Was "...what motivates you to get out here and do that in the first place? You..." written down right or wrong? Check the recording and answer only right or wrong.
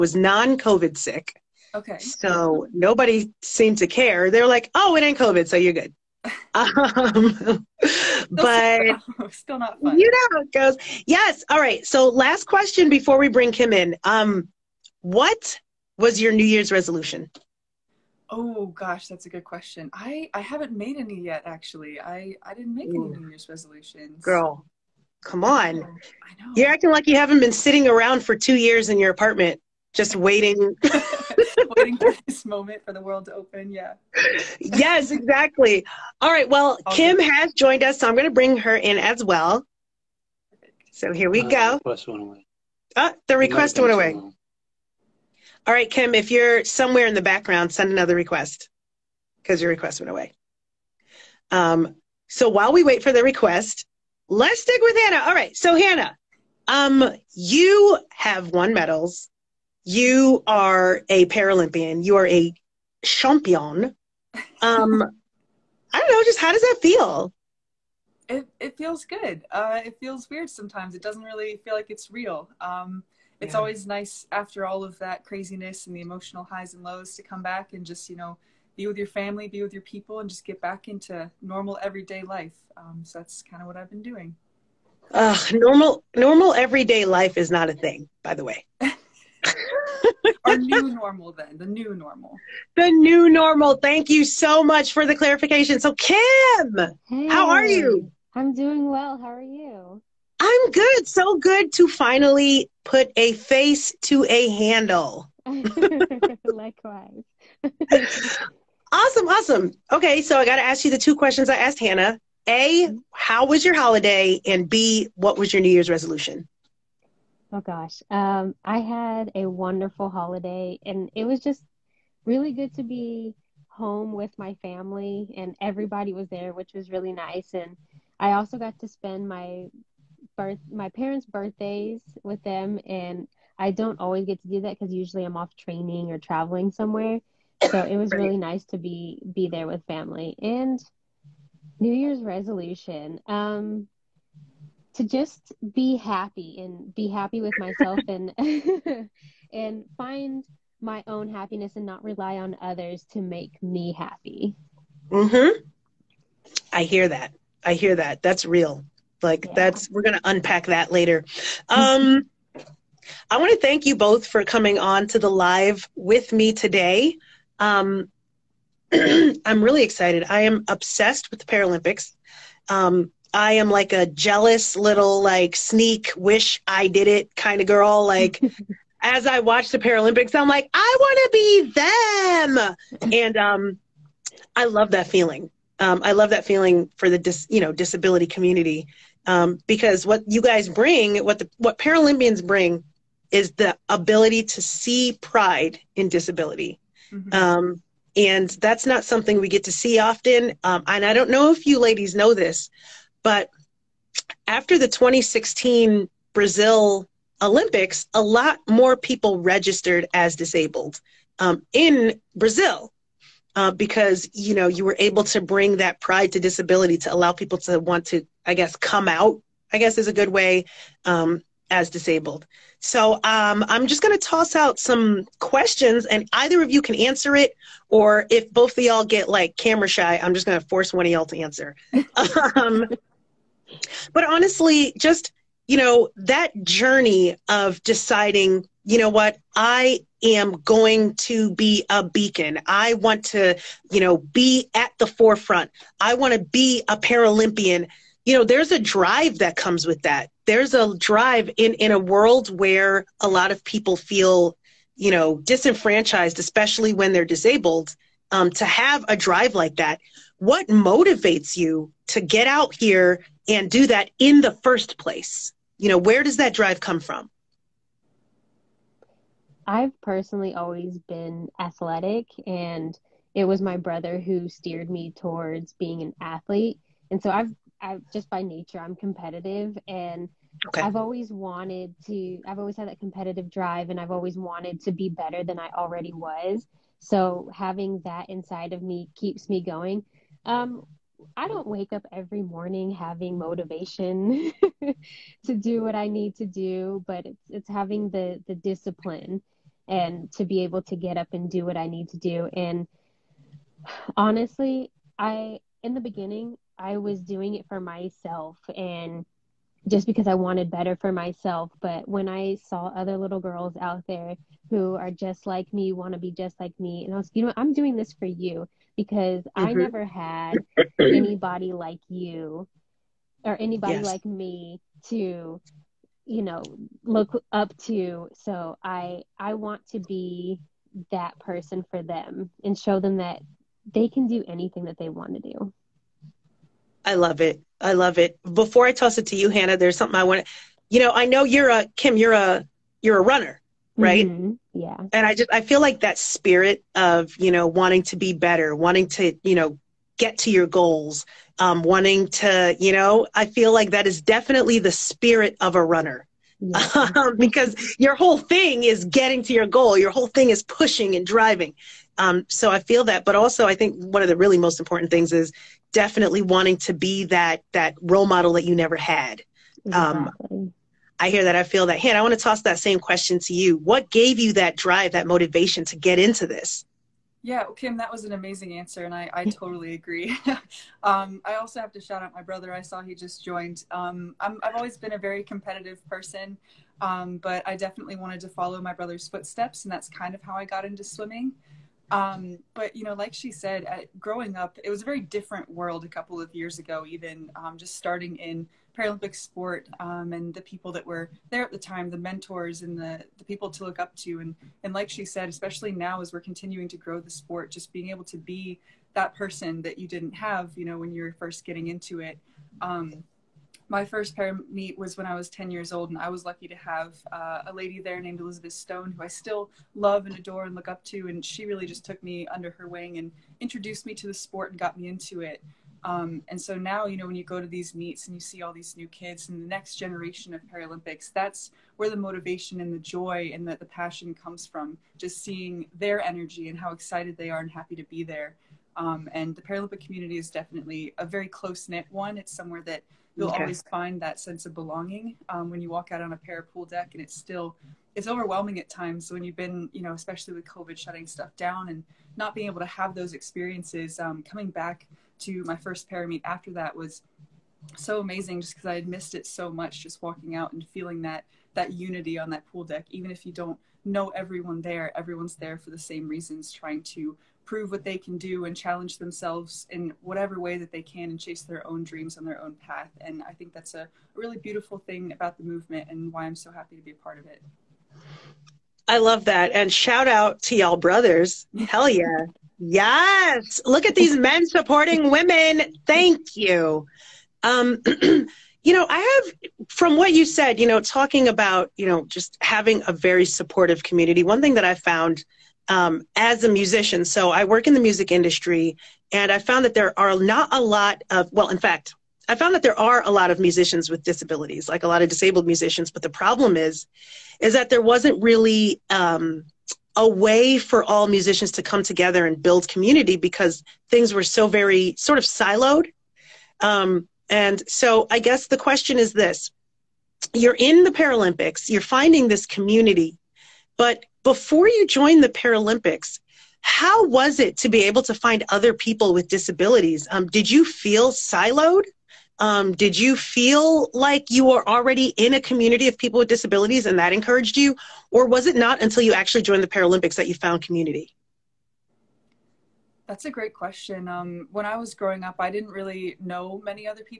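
right.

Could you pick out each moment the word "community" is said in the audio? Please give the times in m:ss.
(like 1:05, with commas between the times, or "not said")
3:08, 7:19, 8:14, 8:32, 8:42, 8:55, 9:00.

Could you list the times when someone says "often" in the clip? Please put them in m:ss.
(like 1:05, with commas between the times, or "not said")
3:19.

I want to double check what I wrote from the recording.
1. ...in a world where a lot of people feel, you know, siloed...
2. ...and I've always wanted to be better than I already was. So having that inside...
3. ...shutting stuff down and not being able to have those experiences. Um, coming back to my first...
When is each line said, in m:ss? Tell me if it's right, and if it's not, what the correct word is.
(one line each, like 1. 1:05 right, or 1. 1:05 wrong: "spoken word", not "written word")
1. 4:11 wrong: "disenfranchised", not "siloed"
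2. 4:43 right
3. 7:30 right.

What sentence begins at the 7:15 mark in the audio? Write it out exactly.
Just seeing their energy and how excited they are and happy to be there.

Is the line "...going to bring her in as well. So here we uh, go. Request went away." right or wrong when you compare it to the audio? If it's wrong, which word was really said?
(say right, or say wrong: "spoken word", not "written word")
right.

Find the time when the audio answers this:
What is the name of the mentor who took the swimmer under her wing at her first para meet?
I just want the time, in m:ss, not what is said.
6:58.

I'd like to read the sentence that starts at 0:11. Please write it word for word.
So last question before we bring Kym in.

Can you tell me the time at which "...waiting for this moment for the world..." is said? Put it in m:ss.
0:31.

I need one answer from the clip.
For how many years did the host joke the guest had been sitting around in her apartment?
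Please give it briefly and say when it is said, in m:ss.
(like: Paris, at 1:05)
2, at 0:28.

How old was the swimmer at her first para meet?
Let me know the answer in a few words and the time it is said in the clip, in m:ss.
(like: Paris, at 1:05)
10, at 6:55.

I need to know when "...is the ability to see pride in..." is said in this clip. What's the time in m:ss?
3:13.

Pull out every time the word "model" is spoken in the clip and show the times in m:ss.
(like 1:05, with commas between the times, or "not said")
6:08.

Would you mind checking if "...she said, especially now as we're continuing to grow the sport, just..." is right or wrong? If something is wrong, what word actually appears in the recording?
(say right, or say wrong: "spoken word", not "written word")
right.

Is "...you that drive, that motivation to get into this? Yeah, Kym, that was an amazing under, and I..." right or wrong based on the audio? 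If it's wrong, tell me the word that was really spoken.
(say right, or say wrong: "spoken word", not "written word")
wrong: "answer", not "under".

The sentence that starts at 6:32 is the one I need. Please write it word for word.
Um, but you know, like she said, at, growing up, it was a very different world a couple of years ago.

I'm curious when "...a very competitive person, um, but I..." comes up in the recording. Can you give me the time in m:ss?
6:25.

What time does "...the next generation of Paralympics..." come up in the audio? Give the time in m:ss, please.
7:09.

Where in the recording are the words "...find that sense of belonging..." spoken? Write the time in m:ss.
7:23.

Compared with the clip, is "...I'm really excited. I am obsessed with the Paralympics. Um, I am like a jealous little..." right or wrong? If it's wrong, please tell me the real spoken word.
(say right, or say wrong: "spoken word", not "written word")
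right.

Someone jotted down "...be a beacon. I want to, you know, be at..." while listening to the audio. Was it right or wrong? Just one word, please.
right.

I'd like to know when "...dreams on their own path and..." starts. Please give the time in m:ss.
7:52.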